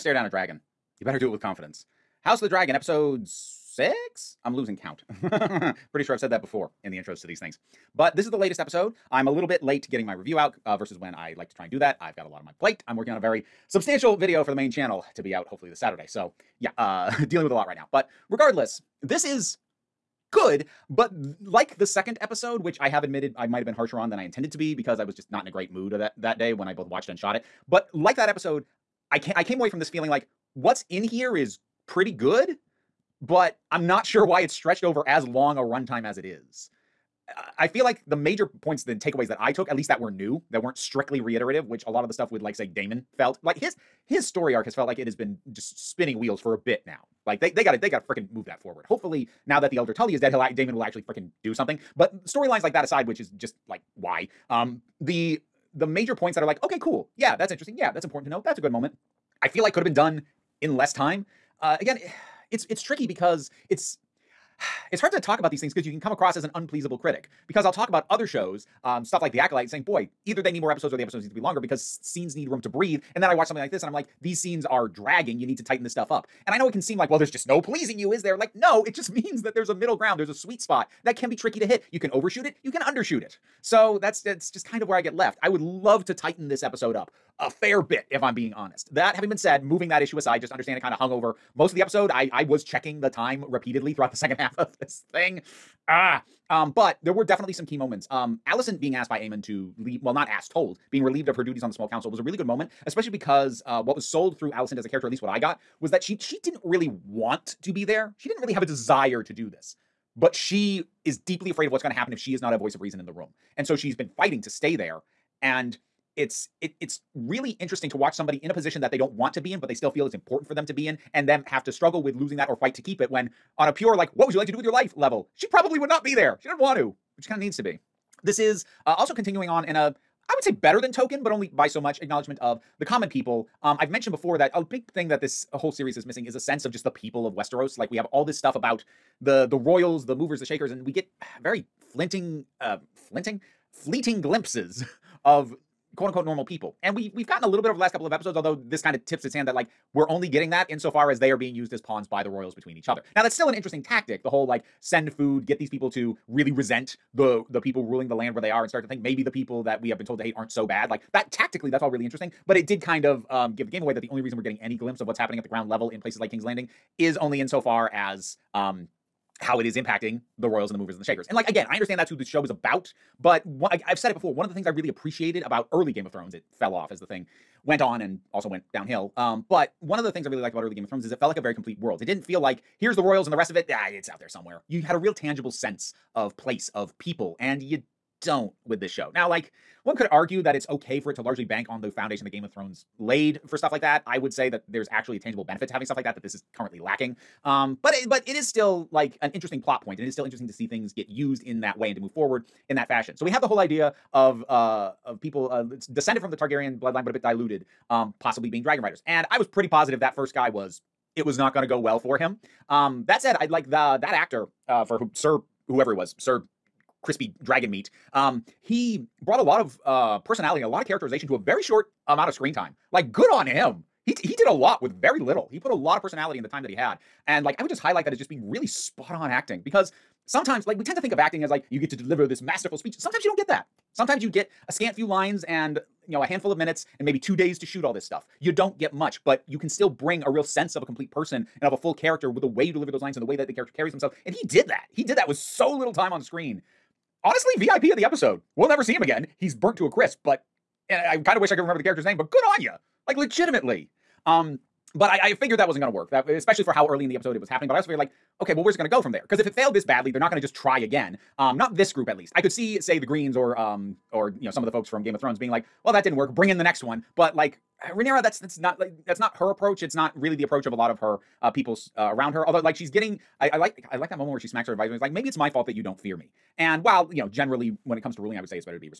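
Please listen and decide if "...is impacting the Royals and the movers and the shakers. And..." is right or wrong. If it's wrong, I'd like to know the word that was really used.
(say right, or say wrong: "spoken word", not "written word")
right.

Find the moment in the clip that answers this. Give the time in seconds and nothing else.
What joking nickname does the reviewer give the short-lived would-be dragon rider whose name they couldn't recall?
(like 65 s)
216 s.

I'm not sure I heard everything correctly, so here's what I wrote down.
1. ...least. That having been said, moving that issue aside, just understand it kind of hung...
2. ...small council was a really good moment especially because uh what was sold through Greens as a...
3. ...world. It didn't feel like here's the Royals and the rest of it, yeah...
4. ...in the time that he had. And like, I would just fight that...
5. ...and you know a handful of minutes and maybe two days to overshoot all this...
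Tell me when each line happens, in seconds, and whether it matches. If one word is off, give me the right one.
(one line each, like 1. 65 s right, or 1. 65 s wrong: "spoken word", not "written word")
1. 88 s wrong: "honest", not "least"
2. 101 s wrong: "Alicent", not "Greens"
3. 181 s right
4. 226 s wrong: "highlight", not "fight"
5. 235 s wrong: "shoot", not "overshoot".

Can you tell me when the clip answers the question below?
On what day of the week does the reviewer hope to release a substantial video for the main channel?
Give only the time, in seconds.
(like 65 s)
15 s.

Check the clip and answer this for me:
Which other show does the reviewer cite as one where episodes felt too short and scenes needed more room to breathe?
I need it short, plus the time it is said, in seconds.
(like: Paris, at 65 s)
The Acolyte, at 69 s.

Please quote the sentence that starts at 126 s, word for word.
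She doesn't want to, but she kind of needs to be.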